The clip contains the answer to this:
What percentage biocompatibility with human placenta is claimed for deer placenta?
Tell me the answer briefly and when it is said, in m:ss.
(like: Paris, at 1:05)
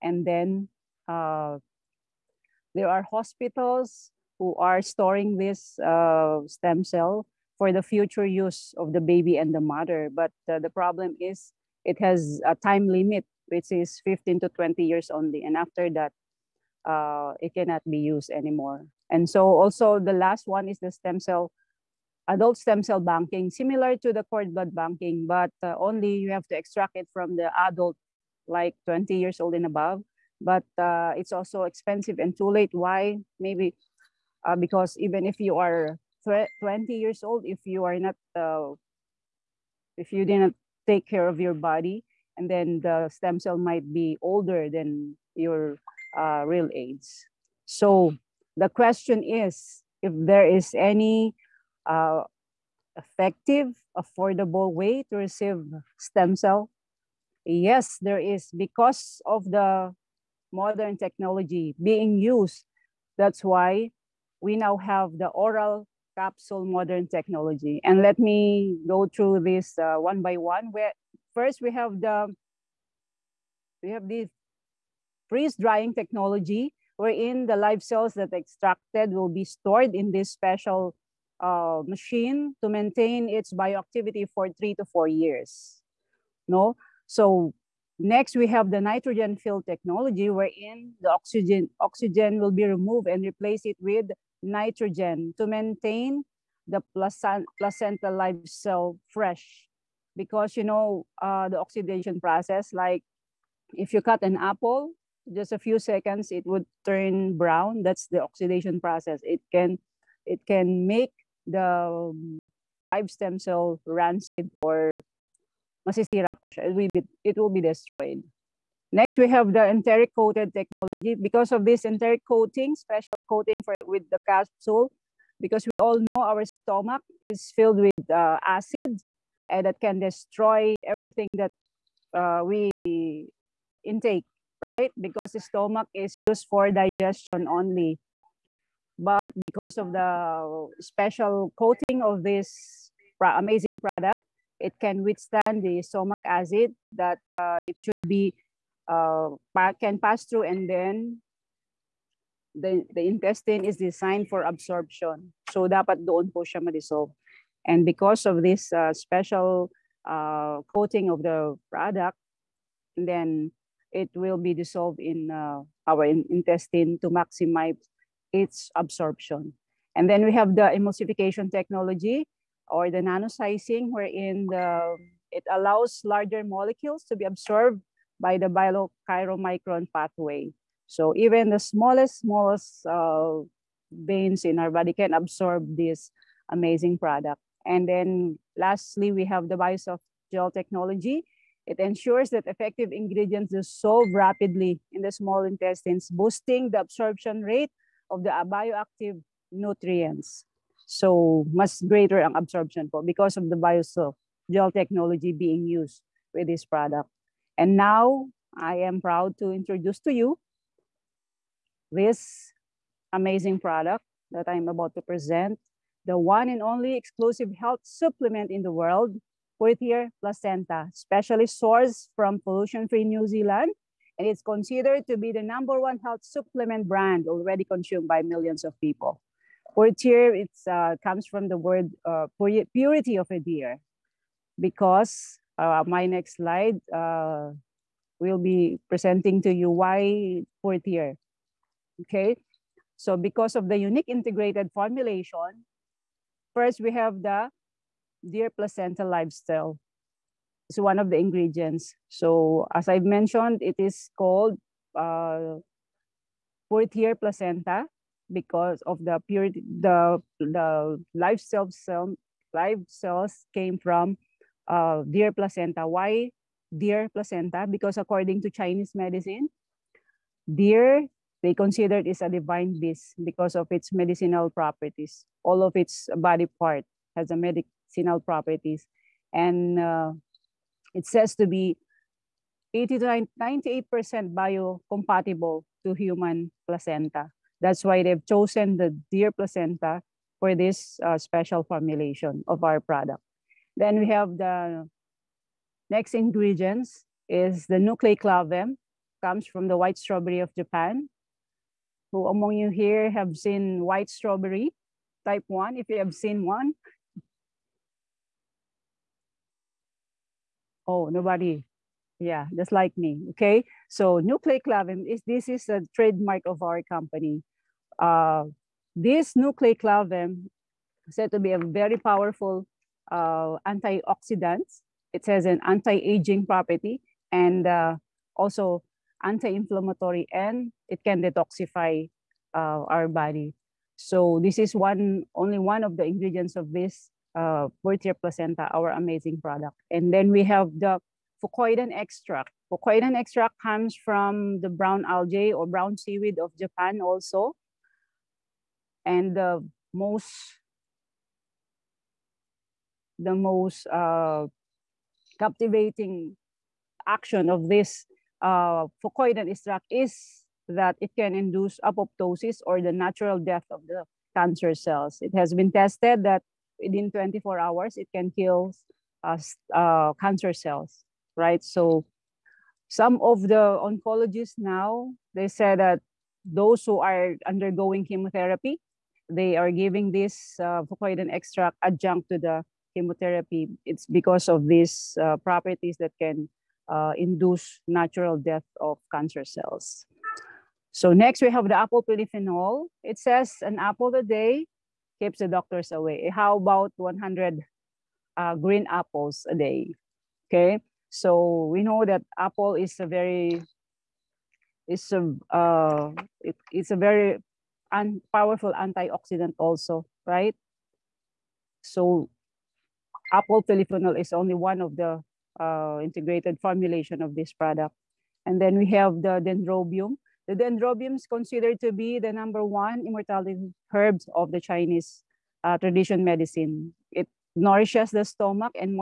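80 to 98%, at 4:42.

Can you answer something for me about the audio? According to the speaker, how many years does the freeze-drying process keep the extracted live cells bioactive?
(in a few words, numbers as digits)
3 to 4 years.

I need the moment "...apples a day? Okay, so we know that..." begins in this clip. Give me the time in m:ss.
6:38.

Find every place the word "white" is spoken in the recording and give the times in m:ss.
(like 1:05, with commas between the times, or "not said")
4:59, 5:03.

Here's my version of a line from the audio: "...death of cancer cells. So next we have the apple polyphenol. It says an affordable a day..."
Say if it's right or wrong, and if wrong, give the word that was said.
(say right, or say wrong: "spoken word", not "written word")
wrong: "apple", not "affordable".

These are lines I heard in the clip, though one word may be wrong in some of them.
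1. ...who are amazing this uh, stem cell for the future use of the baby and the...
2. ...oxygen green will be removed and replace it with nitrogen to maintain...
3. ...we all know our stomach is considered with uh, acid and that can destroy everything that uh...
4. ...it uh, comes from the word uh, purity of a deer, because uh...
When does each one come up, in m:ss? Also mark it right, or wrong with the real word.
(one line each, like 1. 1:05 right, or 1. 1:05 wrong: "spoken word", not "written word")
1. 0:04 wrong: "storing", not "amazing"
2. 1:31 wrong: "oxygen", not "green"
3. 2:05 wrong: "filled", not "considered"
4. 3:50 right.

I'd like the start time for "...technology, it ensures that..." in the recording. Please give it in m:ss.
3:10.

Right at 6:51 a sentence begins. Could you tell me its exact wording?
So apple polyphenol is only one of the uh, integrated formulation of this product.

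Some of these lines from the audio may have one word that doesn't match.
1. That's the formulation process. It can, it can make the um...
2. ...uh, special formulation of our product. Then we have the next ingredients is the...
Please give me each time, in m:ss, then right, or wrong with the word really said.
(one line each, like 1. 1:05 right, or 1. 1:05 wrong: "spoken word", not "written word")
1. 1:47 wrong: "oxidation", not "formulation"
2. 4:51 right.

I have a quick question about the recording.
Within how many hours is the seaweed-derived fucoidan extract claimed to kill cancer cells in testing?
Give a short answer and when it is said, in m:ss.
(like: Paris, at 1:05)
24 hours, at 6:07.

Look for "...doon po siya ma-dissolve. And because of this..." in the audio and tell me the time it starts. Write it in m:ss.
2:36.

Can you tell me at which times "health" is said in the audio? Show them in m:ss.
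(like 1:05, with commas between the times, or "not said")
3:37, 3:45.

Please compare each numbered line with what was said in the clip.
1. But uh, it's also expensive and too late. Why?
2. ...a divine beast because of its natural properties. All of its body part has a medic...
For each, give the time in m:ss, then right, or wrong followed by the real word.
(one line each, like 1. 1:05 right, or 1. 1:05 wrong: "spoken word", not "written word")
1. 0:30 right
2. 4:32 wrong: "medicinal", not "natural".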